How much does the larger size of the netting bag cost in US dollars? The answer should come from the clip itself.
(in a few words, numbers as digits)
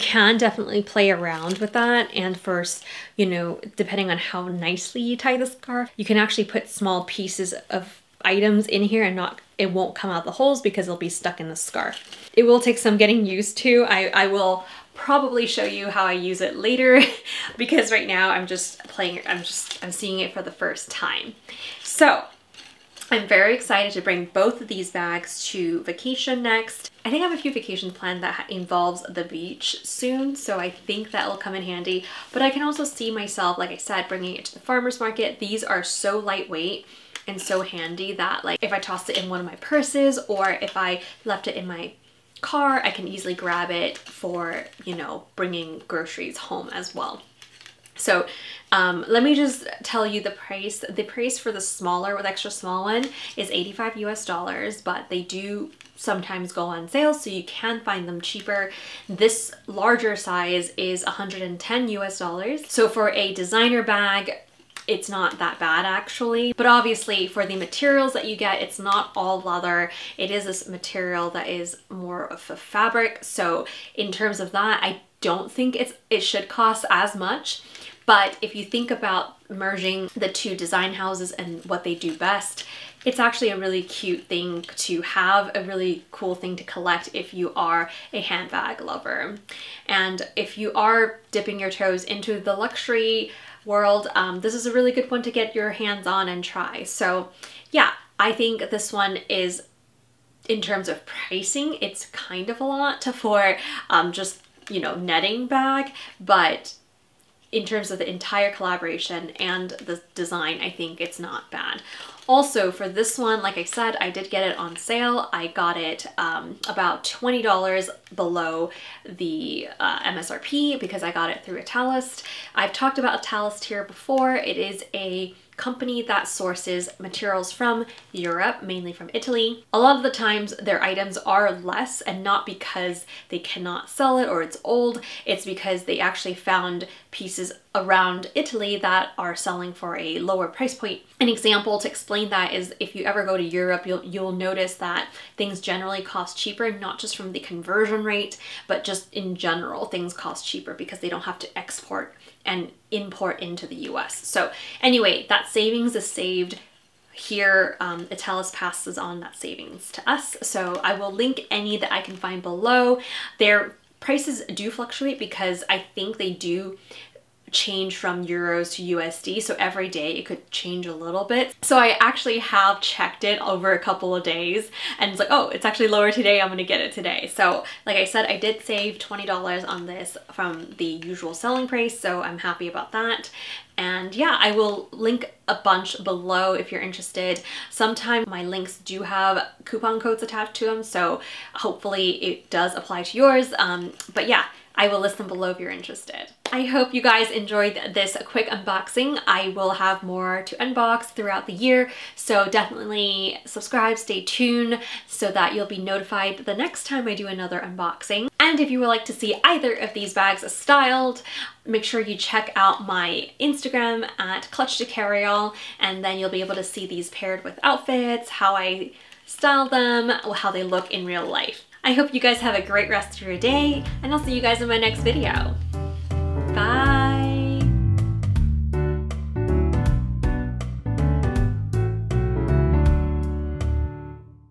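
$110.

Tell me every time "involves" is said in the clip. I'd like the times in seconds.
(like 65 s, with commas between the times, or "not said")
28 s.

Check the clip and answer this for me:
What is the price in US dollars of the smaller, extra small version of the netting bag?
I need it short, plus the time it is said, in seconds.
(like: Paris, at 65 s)
$85, at 53 s.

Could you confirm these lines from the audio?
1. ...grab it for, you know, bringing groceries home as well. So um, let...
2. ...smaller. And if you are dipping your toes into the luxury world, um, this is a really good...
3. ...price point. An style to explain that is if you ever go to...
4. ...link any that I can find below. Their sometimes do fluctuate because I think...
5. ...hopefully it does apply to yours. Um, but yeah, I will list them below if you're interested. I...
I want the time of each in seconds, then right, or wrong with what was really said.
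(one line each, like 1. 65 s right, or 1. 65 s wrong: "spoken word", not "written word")
1. 43 s right
2. 88 s wrong: "lover", not "smaller"
3. 140 s wrong: "example", not "style"
4. 161 s wrong: "prices", not "sometimes"
5. 191 s right.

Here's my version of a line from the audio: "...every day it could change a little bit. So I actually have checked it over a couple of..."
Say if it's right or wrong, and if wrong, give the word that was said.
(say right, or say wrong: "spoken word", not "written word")
right.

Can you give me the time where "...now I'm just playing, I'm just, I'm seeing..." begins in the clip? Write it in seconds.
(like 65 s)
18 s.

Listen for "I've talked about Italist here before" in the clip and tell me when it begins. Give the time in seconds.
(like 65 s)
122 s.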